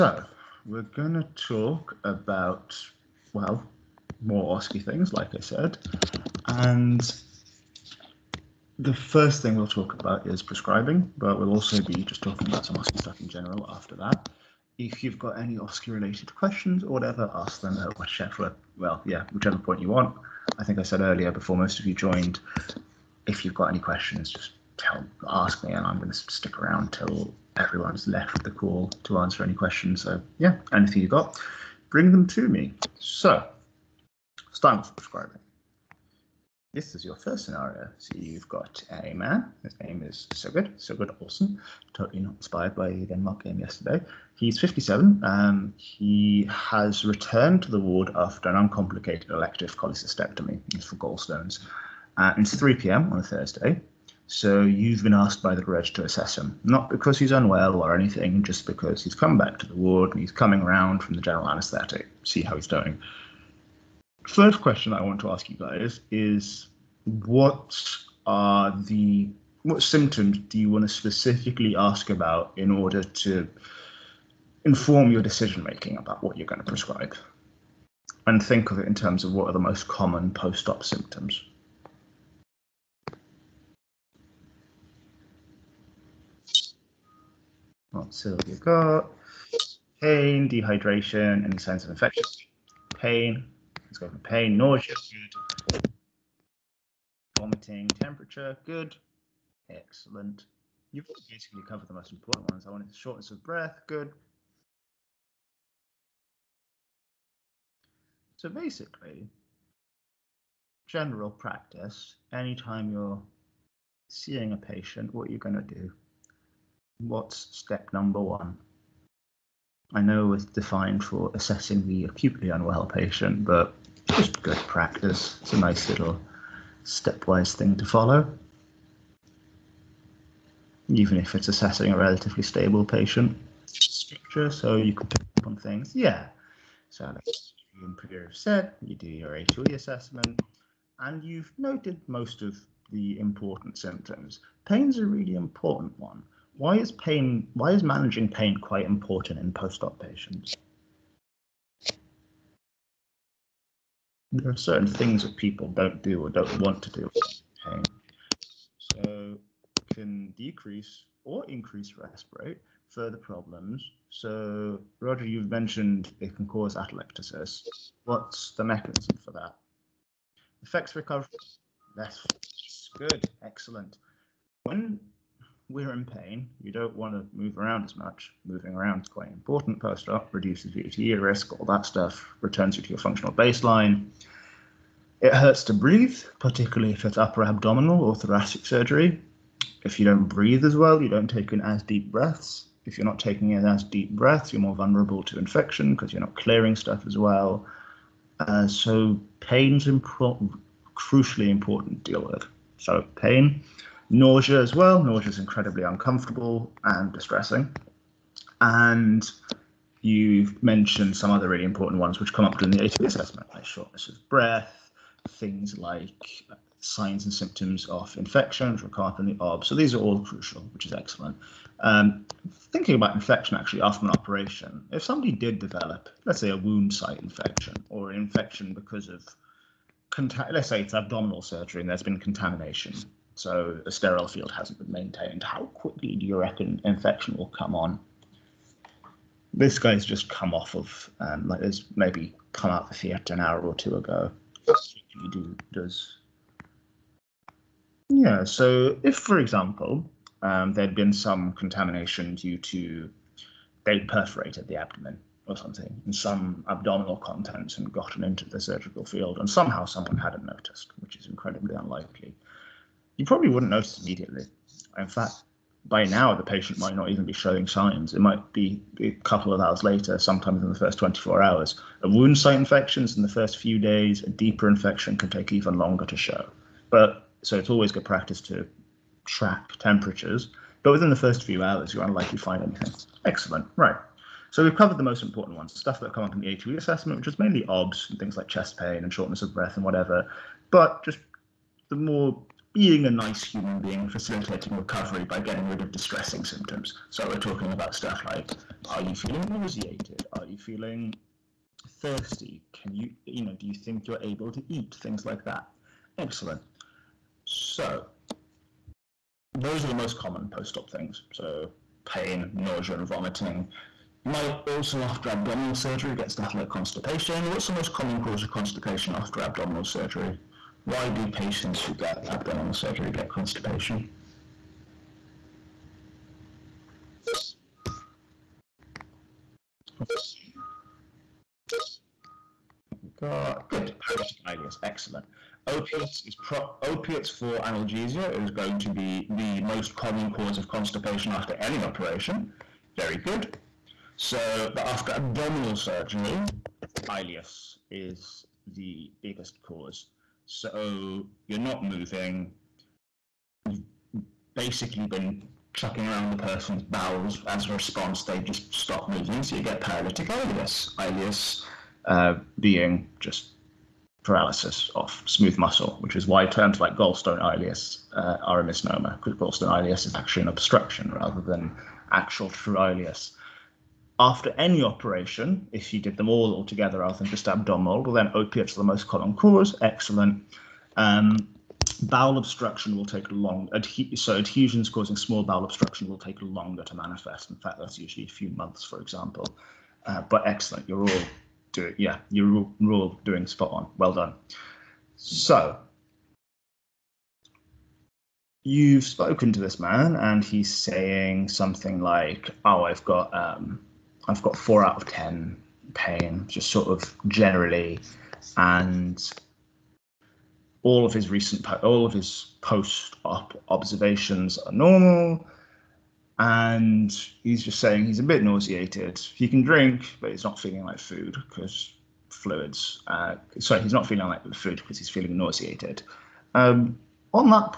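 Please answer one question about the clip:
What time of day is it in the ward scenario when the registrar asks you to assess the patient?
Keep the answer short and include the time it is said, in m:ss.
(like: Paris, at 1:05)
3 p.m., at 0:52.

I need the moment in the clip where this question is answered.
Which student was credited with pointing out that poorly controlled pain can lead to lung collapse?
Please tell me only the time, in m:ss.
2:44.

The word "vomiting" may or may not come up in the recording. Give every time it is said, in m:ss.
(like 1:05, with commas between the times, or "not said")
1:37, 5:13.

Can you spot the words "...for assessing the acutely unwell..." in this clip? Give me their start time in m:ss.
2:01.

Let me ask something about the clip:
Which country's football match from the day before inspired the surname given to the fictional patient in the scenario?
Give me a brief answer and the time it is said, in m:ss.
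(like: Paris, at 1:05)
Denmark, at 0:43.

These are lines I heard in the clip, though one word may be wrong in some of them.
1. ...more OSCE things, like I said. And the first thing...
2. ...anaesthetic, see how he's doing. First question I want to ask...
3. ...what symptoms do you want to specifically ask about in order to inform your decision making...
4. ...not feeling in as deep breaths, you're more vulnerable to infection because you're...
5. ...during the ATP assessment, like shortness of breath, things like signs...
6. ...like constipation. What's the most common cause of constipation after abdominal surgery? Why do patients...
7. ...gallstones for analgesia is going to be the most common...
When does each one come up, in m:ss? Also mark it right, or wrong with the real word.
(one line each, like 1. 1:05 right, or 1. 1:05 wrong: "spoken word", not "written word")
1. 0:04 right
2. 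1:01 right
3. 1:09 right
4. 3:13 wrong: "taking", not "feeling"
5. 3:32 right
6. 5:16 right
7. 5:36 wrong: "opiates", not "gallstones".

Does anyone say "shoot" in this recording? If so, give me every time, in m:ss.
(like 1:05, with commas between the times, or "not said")
not said.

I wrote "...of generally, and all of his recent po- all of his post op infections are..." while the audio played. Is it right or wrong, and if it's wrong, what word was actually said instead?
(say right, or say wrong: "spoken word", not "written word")
wrong: "observations", not "infections".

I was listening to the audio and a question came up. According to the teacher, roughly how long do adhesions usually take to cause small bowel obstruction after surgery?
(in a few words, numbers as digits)
A few months.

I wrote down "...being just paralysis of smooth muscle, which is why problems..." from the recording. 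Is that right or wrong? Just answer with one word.
wrong.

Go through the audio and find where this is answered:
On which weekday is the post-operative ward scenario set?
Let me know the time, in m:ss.
0:53.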